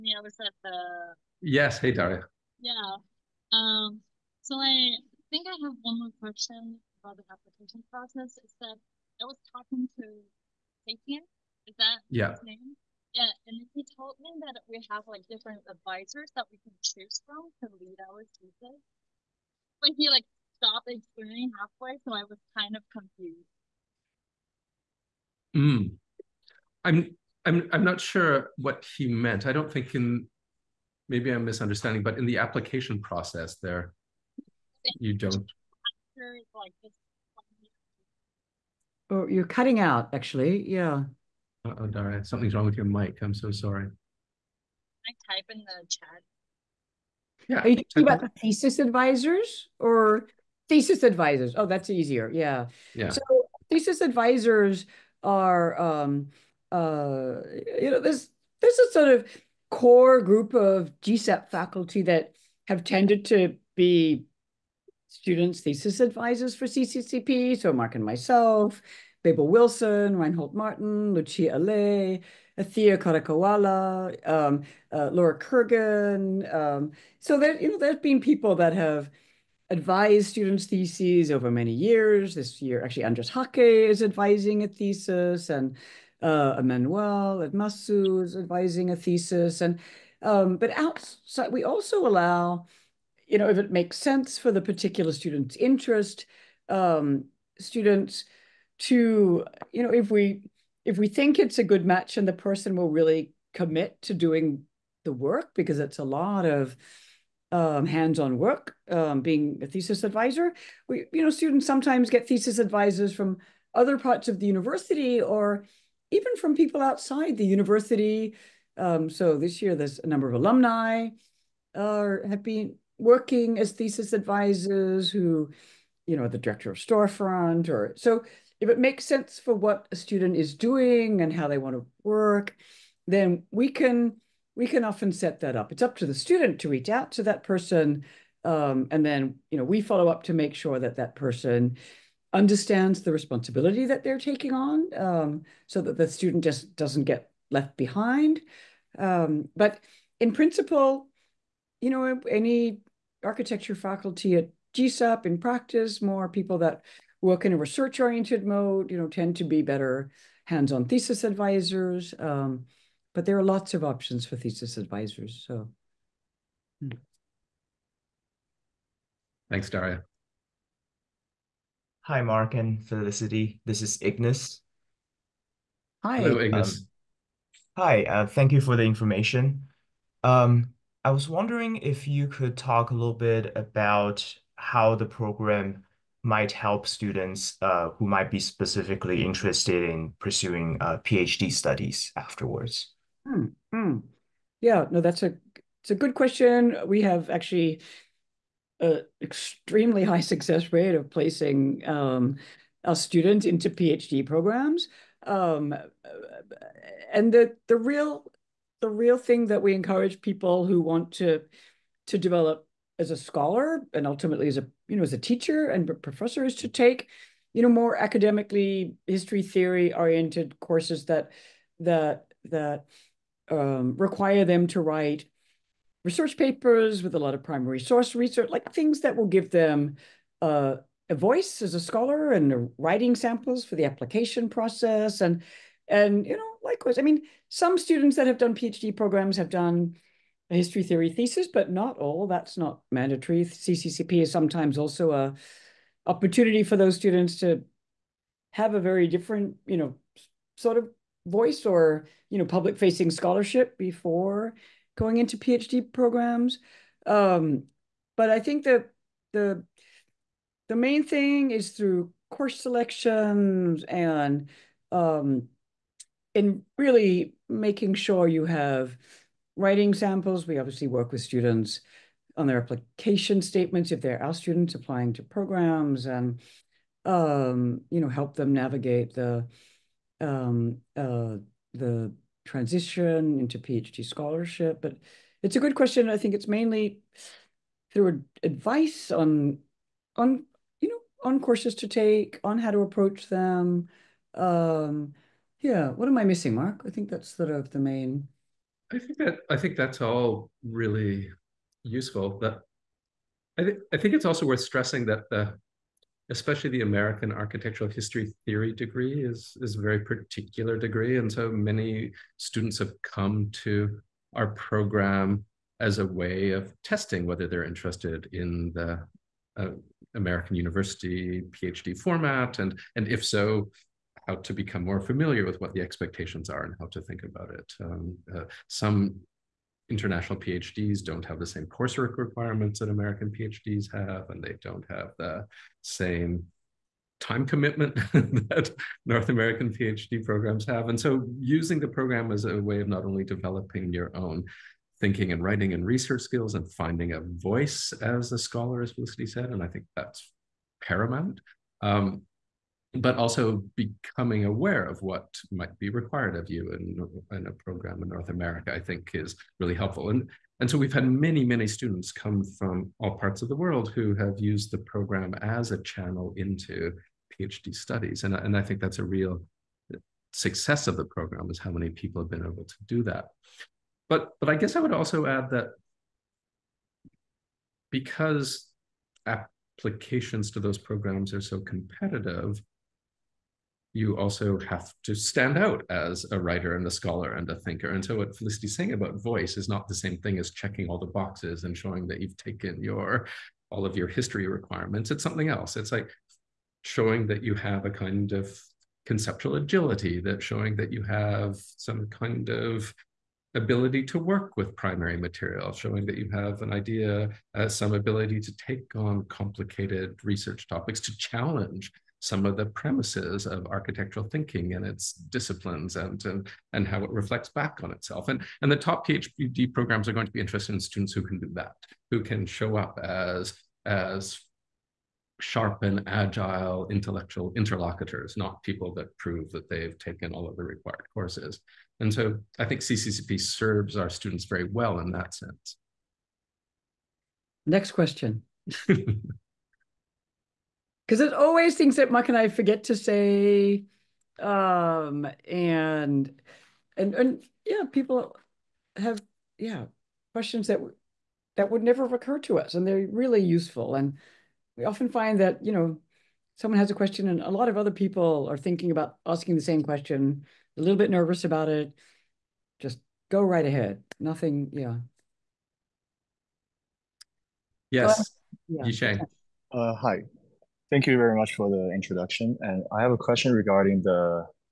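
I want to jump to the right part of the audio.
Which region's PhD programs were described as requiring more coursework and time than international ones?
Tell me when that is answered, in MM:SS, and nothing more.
05:58.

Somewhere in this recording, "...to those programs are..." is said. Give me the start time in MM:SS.
06:20.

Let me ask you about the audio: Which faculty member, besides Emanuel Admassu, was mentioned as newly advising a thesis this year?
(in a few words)
Andrés Jaque.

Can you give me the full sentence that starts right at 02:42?
Um, but there are lots of options for thesis advisors.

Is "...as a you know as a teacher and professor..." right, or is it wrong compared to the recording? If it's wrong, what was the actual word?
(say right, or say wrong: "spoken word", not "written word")
right.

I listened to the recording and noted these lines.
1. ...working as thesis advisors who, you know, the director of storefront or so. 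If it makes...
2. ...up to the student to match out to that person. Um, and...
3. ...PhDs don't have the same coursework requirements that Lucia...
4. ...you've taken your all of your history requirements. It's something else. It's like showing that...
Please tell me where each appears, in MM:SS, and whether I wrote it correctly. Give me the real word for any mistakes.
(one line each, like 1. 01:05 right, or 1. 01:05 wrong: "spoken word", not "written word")
1. 02:02 right
2. 02:15 wrong: "reach", not "match"
3. 05:30 wrong: "American", not "Lucia"
4. 06:32 right.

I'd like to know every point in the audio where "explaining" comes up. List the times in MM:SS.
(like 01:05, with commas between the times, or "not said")
00:20.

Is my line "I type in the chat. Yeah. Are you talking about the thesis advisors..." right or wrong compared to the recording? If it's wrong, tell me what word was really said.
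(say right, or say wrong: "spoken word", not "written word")
right.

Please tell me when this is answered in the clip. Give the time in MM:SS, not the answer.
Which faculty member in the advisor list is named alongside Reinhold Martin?
01:09.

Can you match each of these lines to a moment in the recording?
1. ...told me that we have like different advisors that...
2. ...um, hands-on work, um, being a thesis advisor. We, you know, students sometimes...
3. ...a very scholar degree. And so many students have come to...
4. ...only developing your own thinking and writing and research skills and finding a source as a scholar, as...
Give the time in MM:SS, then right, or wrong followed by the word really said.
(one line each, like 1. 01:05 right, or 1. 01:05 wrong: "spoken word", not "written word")
1. 00:13 right
2. 01:47 right
3. 05:09 wrong: "particular", not "scholar"
4. 05:43 wrong: "voice", not "source".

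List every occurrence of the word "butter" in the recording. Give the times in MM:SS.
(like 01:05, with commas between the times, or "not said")
not said.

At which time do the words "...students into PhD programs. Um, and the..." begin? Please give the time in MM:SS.
03:22.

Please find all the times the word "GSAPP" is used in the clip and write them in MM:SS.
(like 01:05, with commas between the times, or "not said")
01:01, 02:34.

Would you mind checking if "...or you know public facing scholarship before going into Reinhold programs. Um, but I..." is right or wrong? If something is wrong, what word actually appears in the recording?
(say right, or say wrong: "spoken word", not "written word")
wrong: "PhD", not "Reinhold".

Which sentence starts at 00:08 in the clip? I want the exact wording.
Is that I was talking to Sapien.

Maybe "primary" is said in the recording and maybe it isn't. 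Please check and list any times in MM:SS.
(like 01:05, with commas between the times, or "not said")
03:47, 06:44.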